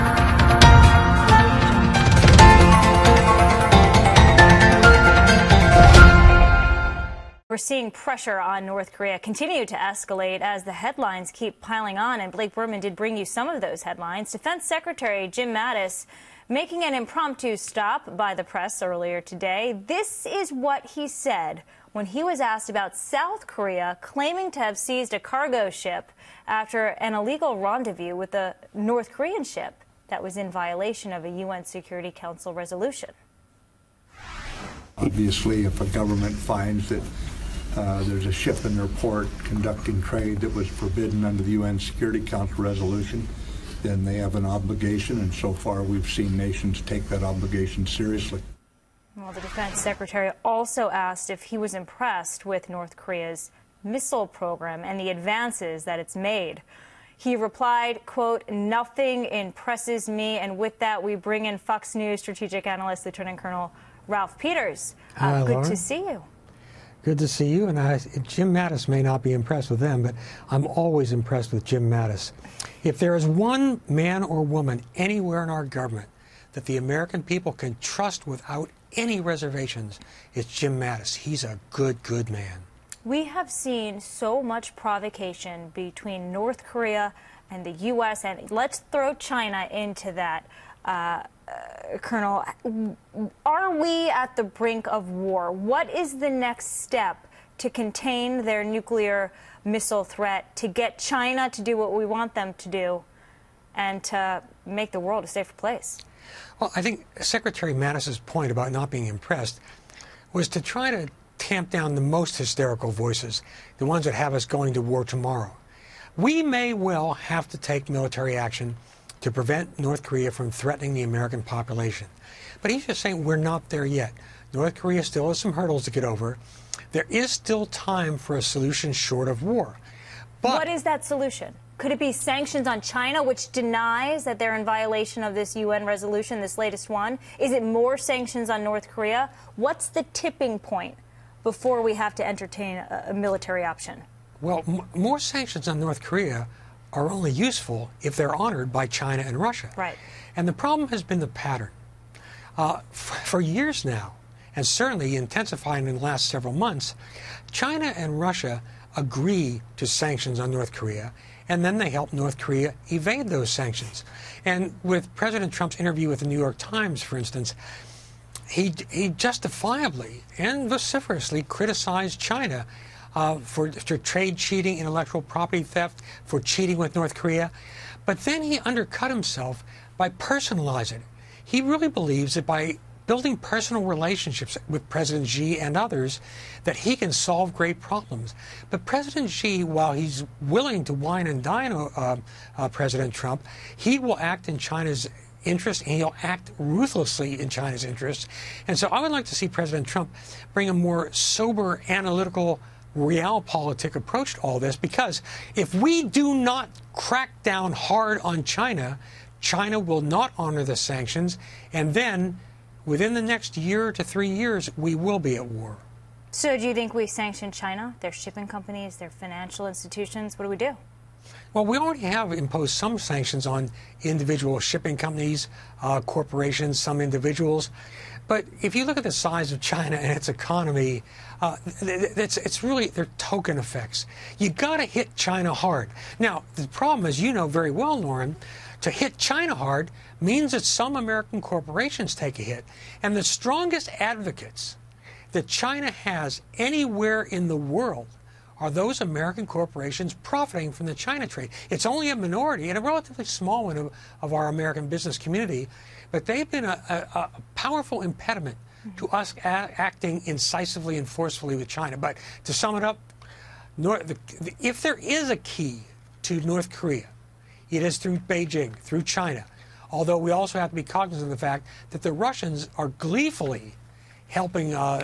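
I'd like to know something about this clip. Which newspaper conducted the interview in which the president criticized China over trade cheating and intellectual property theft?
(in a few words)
New York Times.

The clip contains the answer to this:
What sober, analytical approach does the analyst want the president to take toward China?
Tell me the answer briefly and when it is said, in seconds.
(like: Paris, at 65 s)
Realpolitik, at 202 s.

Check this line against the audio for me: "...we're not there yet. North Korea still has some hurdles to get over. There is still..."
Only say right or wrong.
right.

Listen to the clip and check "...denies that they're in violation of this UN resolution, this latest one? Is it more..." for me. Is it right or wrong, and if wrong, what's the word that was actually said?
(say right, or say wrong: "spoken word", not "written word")
right.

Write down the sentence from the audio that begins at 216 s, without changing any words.
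So, do you think we sanction China, their shipping companies, their financial institutions?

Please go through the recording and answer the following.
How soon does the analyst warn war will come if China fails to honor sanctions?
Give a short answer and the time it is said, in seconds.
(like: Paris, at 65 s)
1 to 3 years, at 213 s.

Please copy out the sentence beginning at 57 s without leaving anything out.
He replied, quote, nothing impresses me.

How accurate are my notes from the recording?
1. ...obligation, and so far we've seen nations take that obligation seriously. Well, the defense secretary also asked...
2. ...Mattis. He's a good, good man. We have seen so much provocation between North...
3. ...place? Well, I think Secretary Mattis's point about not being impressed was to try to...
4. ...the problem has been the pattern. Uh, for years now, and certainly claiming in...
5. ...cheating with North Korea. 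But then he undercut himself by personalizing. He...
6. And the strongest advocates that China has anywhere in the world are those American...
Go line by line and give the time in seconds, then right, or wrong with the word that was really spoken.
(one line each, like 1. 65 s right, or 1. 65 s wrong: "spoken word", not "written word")
1. 44 s right
2. 80 s right
3. 105 s right
4. 150 s wrong: "intensifying", not "claiming"
5. 176 s right
6. 243 s right.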